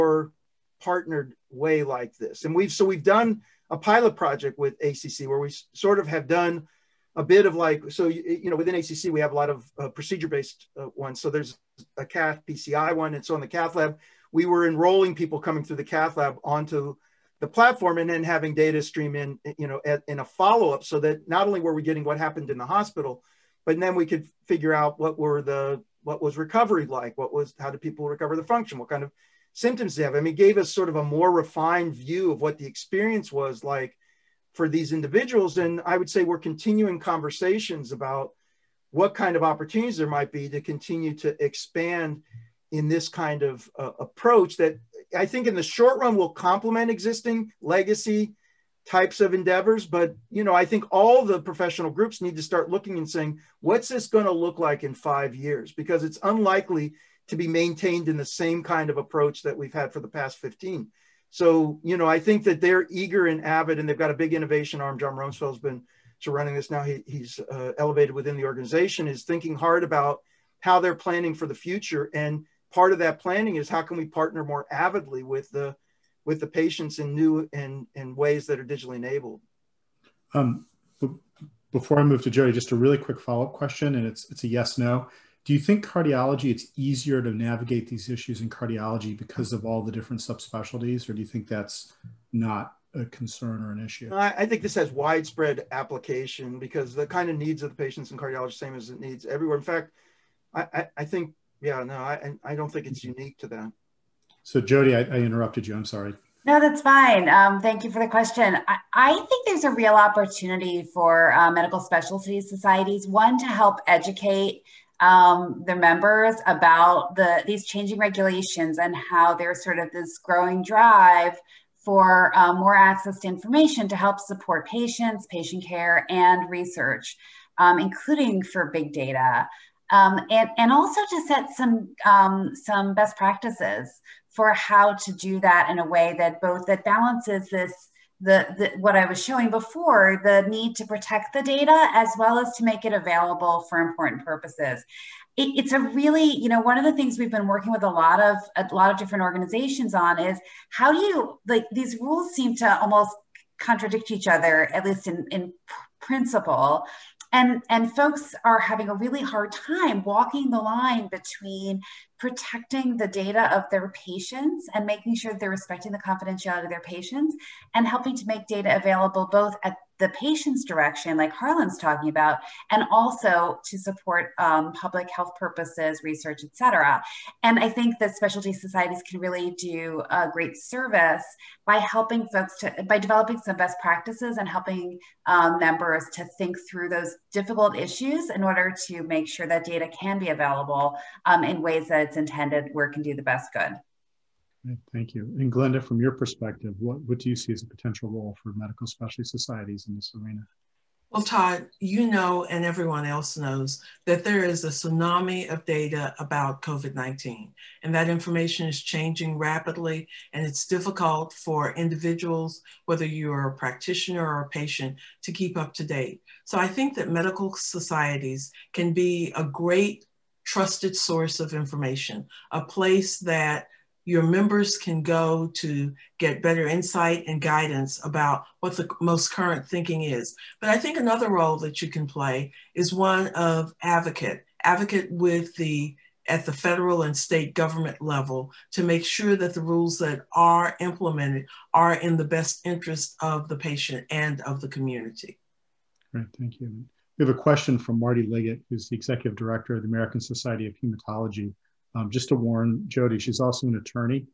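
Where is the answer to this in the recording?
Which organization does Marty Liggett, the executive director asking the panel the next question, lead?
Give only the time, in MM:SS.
04:09.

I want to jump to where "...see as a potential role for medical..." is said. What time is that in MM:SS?
03:17.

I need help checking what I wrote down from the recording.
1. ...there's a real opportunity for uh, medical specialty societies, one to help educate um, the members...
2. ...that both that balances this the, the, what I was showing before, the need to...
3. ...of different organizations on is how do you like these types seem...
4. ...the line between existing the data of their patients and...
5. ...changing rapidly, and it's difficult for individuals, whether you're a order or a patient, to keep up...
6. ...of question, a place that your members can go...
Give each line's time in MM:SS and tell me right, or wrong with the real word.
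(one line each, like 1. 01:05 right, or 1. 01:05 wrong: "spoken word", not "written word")
1. 01:49 right
2. 02:16 right
3. 02:28 wrong: "rules", not "types"
4. 02:40 wrong: "protecting", not "existing"
5. 03:28 wrong: "practitioner", not "order"
6. 03:41 wrong: "information", not "question".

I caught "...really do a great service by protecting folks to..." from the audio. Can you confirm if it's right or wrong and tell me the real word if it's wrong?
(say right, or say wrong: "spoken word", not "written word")
wrong: "helping", not "protecting".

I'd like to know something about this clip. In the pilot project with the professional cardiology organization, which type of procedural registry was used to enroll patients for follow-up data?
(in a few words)
Cath PCI.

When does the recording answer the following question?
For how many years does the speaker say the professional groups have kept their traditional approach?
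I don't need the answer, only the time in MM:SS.
01:00.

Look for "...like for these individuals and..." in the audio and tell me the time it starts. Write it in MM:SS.
00:33.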